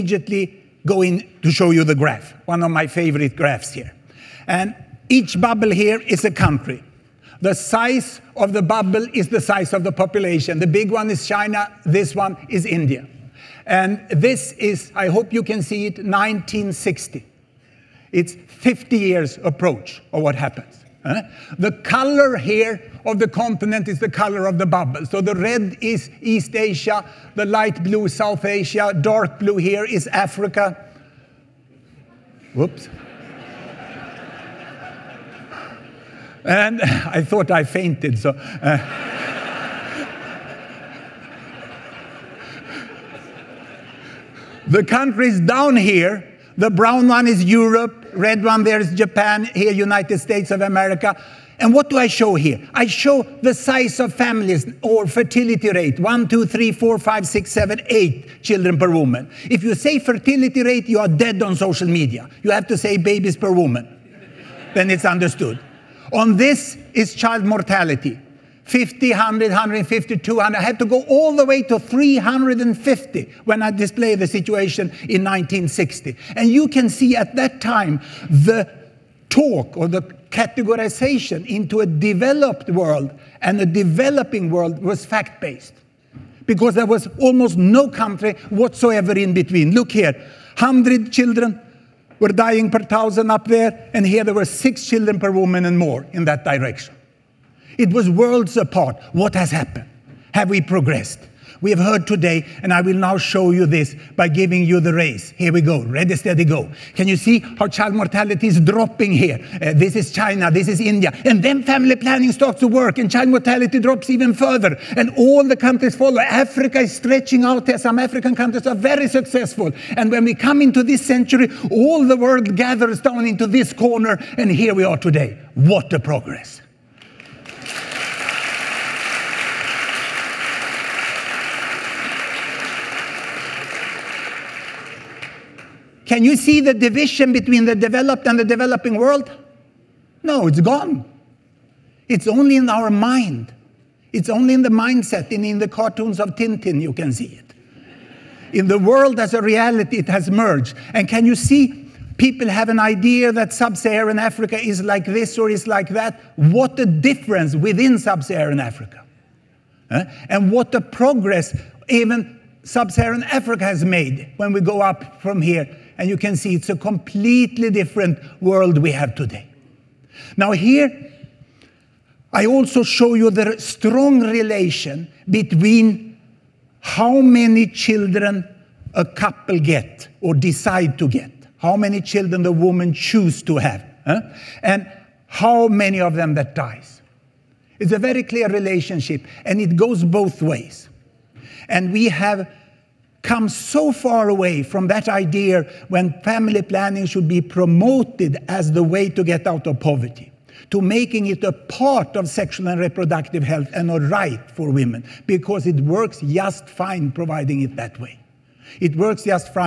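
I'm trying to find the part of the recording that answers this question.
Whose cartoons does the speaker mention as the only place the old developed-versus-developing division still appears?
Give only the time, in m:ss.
2:26.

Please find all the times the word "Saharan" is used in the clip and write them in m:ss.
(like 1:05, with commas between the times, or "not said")
2:33, 2:38, 2:42.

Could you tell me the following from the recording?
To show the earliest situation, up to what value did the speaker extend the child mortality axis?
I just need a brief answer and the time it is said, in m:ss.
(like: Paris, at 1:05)
350, at 1:11.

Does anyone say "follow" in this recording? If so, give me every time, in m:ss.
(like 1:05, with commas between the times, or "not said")
1:55.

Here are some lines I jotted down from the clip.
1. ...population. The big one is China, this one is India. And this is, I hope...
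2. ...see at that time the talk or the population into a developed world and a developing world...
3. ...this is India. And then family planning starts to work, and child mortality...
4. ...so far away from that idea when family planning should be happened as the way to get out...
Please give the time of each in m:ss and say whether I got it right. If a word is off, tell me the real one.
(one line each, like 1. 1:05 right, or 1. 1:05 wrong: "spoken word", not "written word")
1. 0:09 right
2. 1:16 wrong: "categorization", not "population"
3. 1:50 right
4. 3:13 wrong: "promoted", not "happened".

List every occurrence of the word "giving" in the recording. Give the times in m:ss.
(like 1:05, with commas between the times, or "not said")
1:44.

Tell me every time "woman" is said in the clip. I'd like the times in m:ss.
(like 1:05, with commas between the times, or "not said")
0:58, 1:03, 1:35, 3:02.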